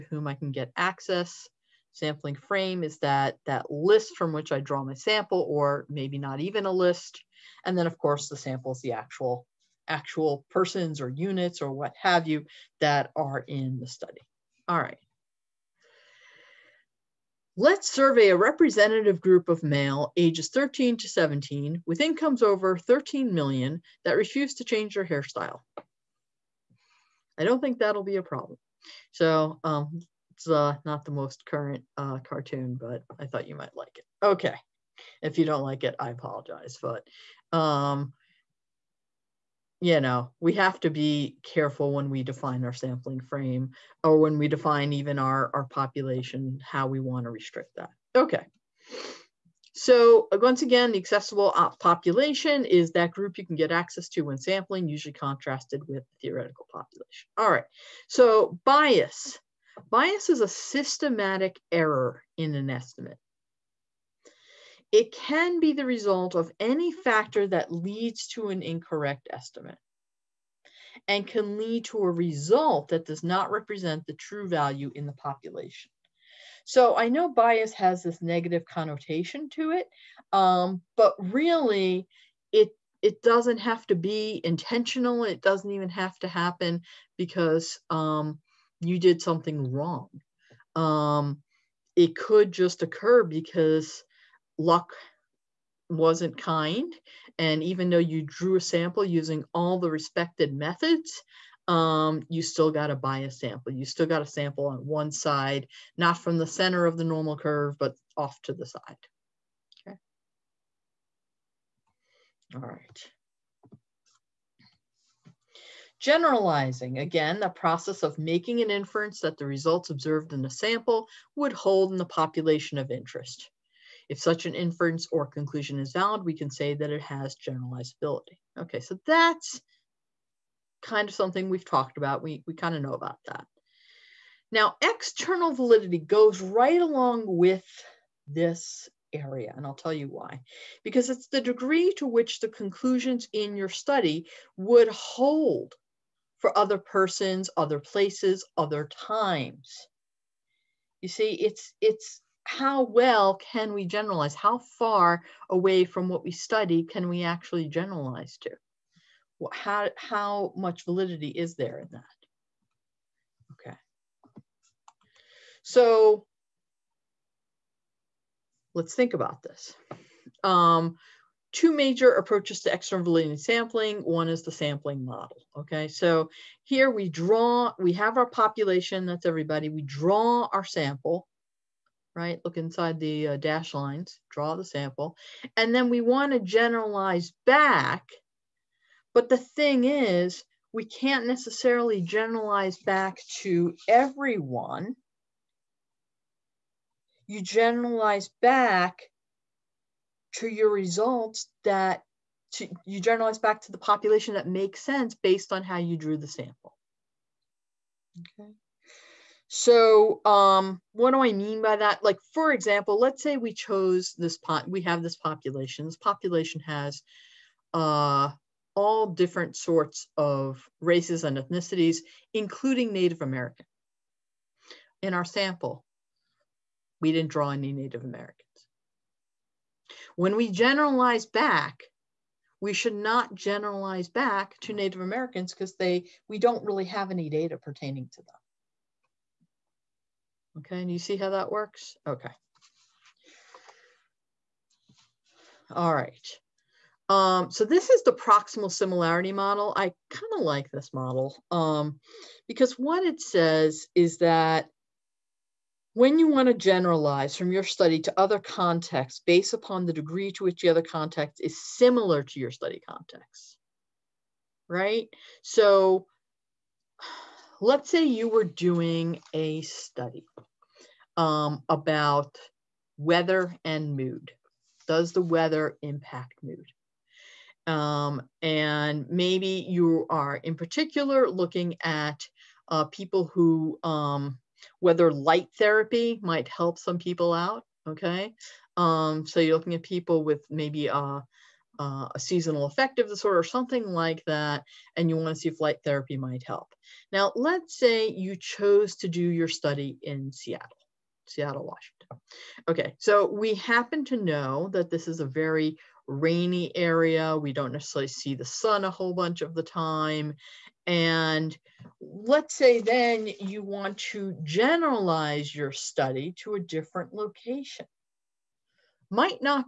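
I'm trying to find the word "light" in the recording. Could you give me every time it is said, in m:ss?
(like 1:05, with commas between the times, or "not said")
4:45, 4:55.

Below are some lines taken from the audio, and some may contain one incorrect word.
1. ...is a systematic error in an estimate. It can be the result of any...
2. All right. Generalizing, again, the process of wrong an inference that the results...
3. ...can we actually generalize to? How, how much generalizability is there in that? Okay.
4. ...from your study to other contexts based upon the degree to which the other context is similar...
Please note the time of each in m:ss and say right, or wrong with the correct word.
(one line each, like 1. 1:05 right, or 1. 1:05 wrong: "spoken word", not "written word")
1. 1:00 right
2. 1:52 wrong: "making", not "wrong"
3. 2:36 wrong: "validity", not "generalizability"
4. 4:17 right.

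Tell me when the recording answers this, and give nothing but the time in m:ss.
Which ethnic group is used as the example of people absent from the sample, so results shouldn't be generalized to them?
3:42.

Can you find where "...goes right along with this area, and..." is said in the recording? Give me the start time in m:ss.
2:15.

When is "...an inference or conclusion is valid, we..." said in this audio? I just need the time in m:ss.
2:04.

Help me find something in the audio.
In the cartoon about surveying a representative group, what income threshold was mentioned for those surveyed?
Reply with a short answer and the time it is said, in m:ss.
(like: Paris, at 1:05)
13 million, at 0:22.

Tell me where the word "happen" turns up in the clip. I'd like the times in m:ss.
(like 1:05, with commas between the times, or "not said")
1:26, 5:03.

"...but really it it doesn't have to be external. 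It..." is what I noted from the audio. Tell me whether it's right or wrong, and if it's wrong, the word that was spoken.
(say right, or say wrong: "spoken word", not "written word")
wrong: "intentional", not "external".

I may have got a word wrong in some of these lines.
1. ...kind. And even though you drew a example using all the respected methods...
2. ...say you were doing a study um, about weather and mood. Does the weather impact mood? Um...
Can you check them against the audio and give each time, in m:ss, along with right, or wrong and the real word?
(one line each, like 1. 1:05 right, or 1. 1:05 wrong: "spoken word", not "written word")
1. 1:36 wrong: "sample", not "example"
2. 4:27 right.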